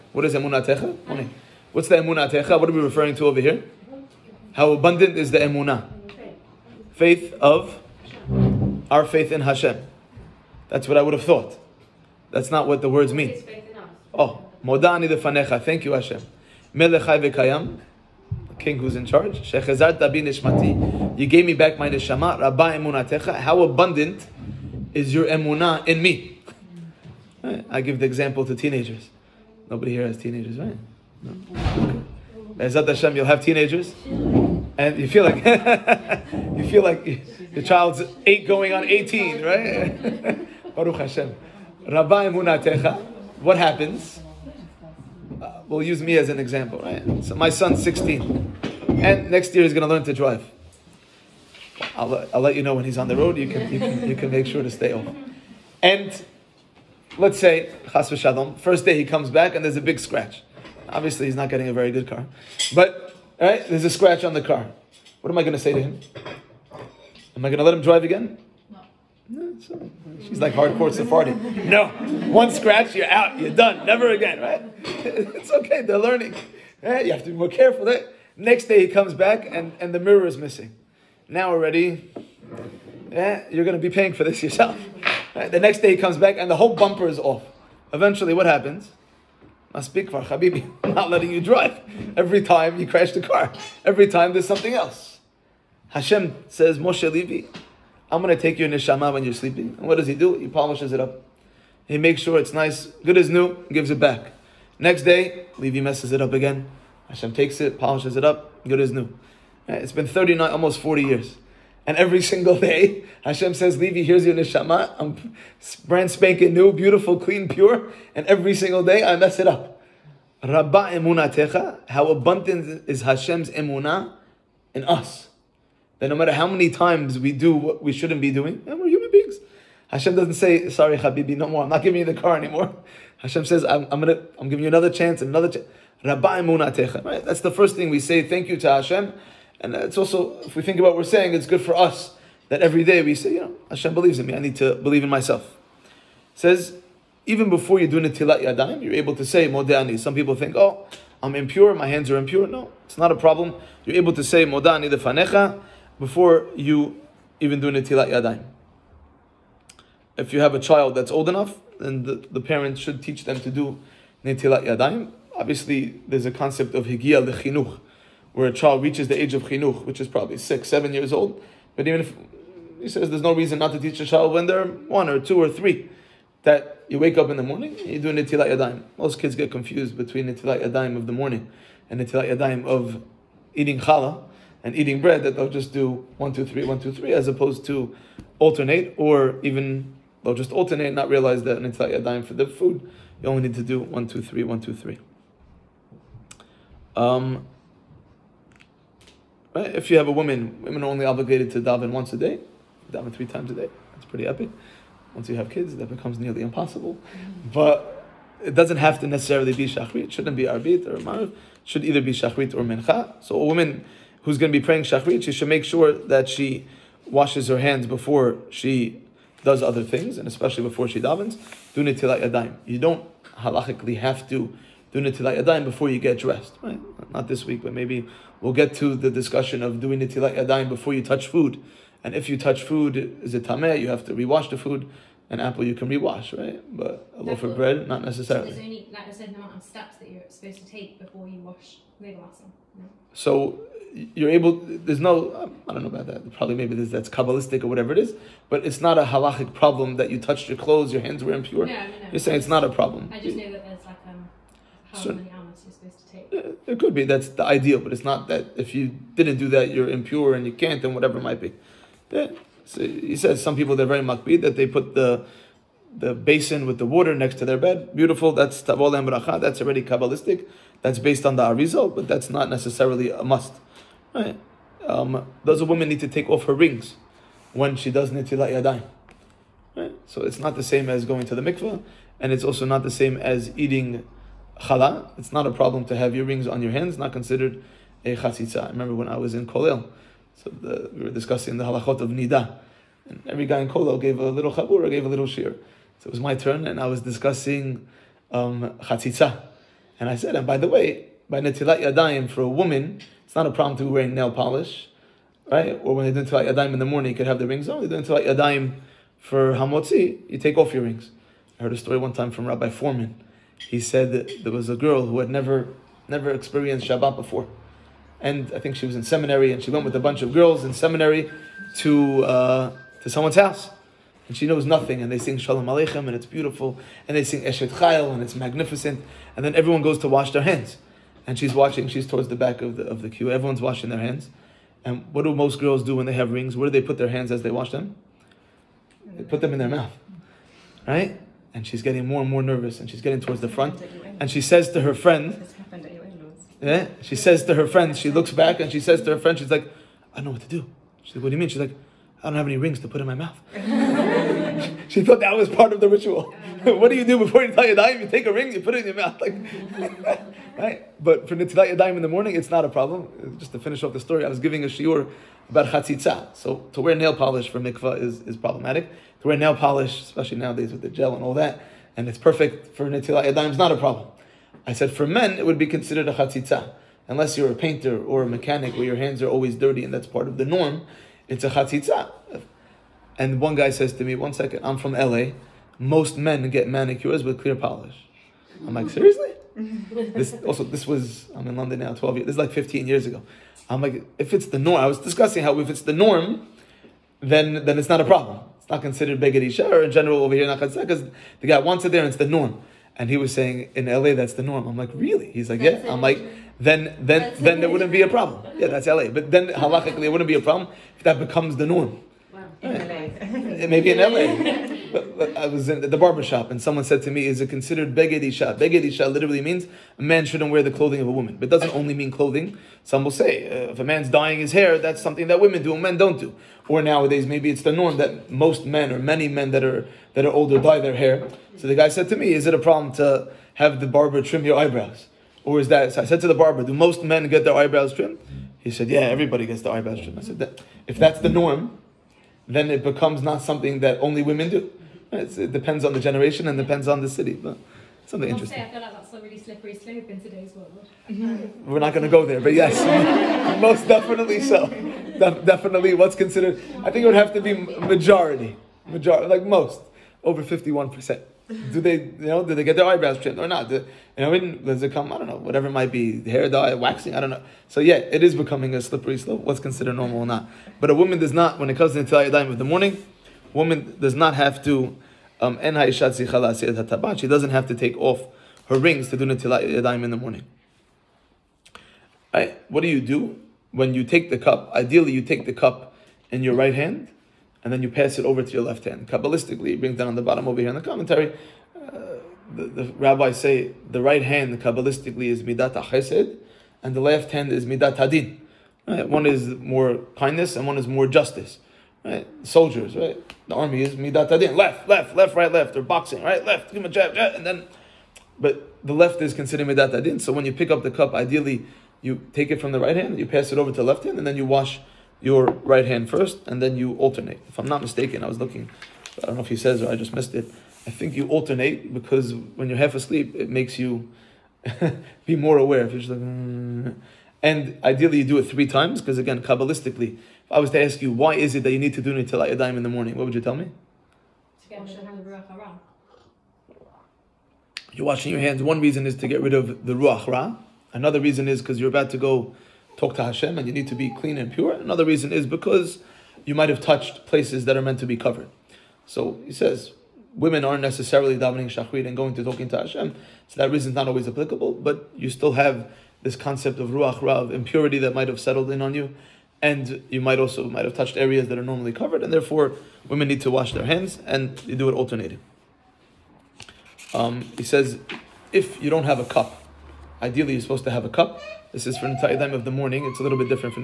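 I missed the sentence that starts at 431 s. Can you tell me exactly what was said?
So the guy said to me, "Is it a problem to have the barber trim your eyebrows?" Or is that?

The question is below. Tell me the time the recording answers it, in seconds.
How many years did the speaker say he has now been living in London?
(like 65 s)
391 s.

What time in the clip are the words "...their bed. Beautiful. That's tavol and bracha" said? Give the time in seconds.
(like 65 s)
267 s.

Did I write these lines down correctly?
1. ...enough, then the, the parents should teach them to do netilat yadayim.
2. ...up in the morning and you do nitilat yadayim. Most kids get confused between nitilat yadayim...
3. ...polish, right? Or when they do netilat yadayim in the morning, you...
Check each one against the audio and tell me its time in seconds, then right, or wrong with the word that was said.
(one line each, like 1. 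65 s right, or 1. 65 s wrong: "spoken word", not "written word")
1. 161 s right
2. 177 s right
3. 304 s right.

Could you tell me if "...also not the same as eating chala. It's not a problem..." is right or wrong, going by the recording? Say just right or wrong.
right.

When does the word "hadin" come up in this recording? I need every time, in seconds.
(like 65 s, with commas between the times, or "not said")
497 s, 504 s, 509 s.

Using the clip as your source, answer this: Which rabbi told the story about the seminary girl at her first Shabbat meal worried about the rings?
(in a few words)
Rabbi Foreman.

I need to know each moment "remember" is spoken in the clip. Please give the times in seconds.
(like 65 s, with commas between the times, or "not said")
288 s.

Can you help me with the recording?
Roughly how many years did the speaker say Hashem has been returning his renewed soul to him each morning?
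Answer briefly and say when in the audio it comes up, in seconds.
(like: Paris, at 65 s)
Almost 40 years, at 110 s.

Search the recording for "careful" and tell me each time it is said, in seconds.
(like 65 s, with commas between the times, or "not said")
77 s.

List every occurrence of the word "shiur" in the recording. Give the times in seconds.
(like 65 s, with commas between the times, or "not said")
364 s.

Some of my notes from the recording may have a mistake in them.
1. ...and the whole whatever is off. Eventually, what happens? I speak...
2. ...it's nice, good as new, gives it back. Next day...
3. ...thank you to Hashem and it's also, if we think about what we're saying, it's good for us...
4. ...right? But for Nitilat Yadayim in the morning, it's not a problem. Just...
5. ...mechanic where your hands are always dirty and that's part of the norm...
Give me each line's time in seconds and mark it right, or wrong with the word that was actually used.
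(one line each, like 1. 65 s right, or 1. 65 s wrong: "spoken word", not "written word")
1. 86 s wrong: "bumper", not "whatever"
2. 102 s right
3. 138 s right
4. 360 s right
5. 378 s right.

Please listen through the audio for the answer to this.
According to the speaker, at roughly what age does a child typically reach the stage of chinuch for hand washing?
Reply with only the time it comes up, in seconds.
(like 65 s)
170 s.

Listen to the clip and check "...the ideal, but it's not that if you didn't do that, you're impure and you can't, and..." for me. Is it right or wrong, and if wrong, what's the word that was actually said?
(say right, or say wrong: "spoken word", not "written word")
right.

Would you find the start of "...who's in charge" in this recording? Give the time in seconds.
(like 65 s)
18 s.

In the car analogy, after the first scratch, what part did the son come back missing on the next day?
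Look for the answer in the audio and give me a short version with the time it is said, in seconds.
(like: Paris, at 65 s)
The mirror, at 79 s.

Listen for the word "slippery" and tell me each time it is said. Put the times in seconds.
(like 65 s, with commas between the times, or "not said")
449 s, 468 s.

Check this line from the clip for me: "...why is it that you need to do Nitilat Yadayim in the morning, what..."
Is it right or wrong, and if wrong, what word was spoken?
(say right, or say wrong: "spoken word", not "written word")
right.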